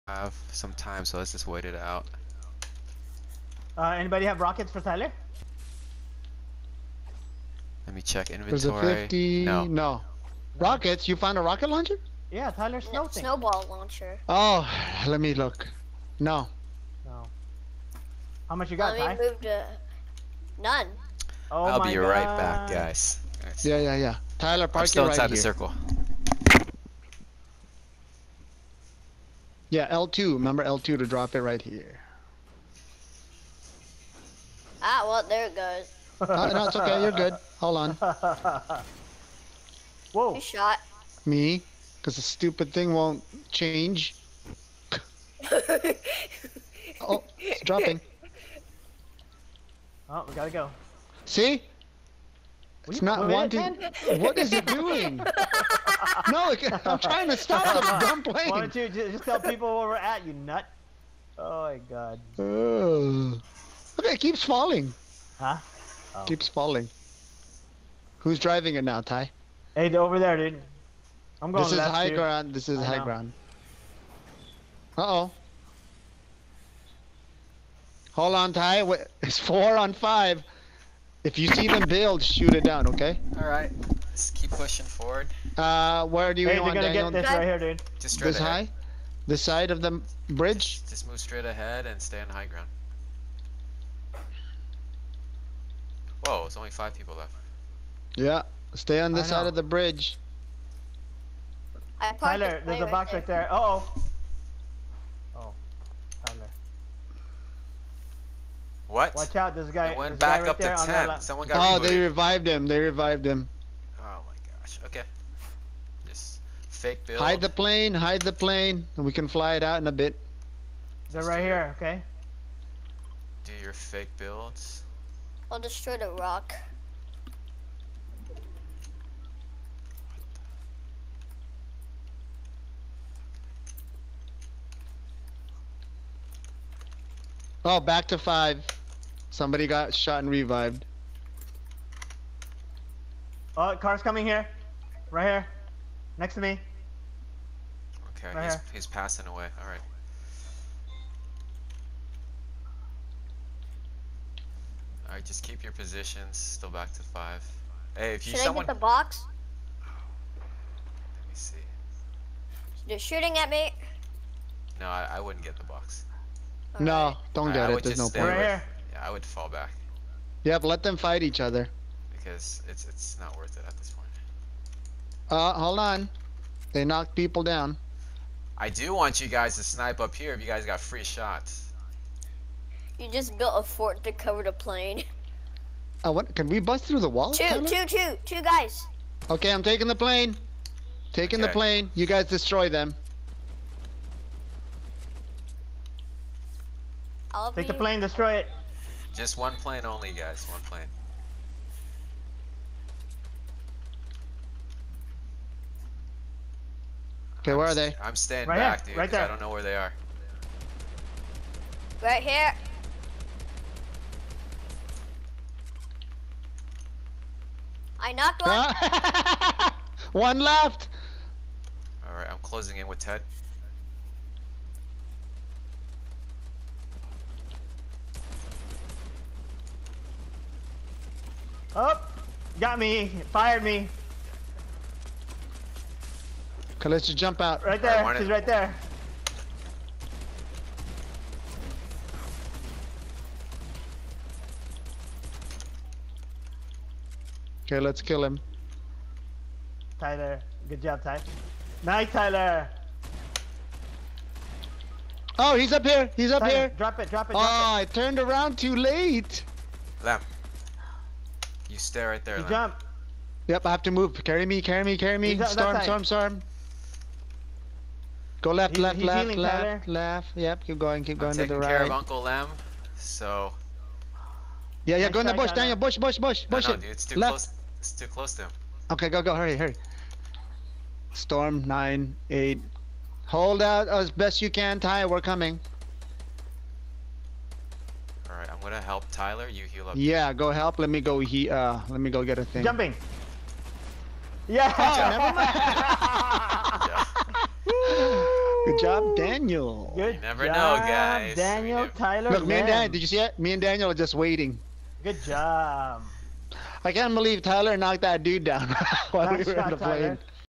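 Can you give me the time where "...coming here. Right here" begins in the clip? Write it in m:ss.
2:24.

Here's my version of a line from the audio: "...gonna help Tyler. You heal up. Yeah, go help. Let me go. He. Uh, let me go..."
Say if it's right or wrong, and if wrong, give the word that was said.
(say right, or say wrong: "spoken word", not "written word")
right.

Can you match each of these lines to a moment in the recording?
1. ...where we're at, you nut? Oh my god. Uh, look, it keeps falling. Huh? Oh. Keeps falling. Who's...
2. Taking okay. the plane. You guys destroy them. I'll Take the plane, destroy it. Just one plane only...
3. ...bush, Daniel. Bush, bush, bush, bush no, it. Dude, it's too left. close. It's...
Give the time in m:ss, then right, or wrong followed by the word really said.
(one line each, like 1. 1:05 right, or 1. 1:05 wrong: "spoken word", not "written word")
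1. 0:59 right
2. 3:11 right
3. 4:35 right.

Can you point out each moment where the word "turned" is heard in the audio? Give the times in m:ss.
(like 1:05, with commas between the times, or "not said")
4:17.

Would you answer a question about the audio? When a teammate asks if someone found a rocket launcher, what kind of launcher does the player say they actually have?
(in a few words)
Snowball launcher.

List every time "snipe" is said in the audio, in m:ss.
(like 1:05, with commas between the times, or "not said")
2:59.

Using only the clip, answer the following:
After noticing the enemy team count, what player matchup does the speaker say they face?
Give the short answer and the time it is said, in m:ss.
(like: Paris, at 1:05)
4 on 5, at 1:19.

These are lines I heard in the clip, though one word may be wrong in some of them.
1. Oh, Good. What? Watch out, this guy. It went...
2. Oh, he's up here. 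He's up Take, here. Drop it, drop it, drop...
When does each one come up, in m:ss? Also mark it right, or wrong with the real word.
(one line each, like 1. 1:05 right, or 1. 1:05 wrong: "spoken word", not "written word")
1. 1:45 wrong: "Tyler", not "Good"
2. 4:15 wrong: "Tyler", not "Take".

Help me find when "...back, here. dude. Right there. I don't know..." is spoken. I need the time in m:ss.
3:28.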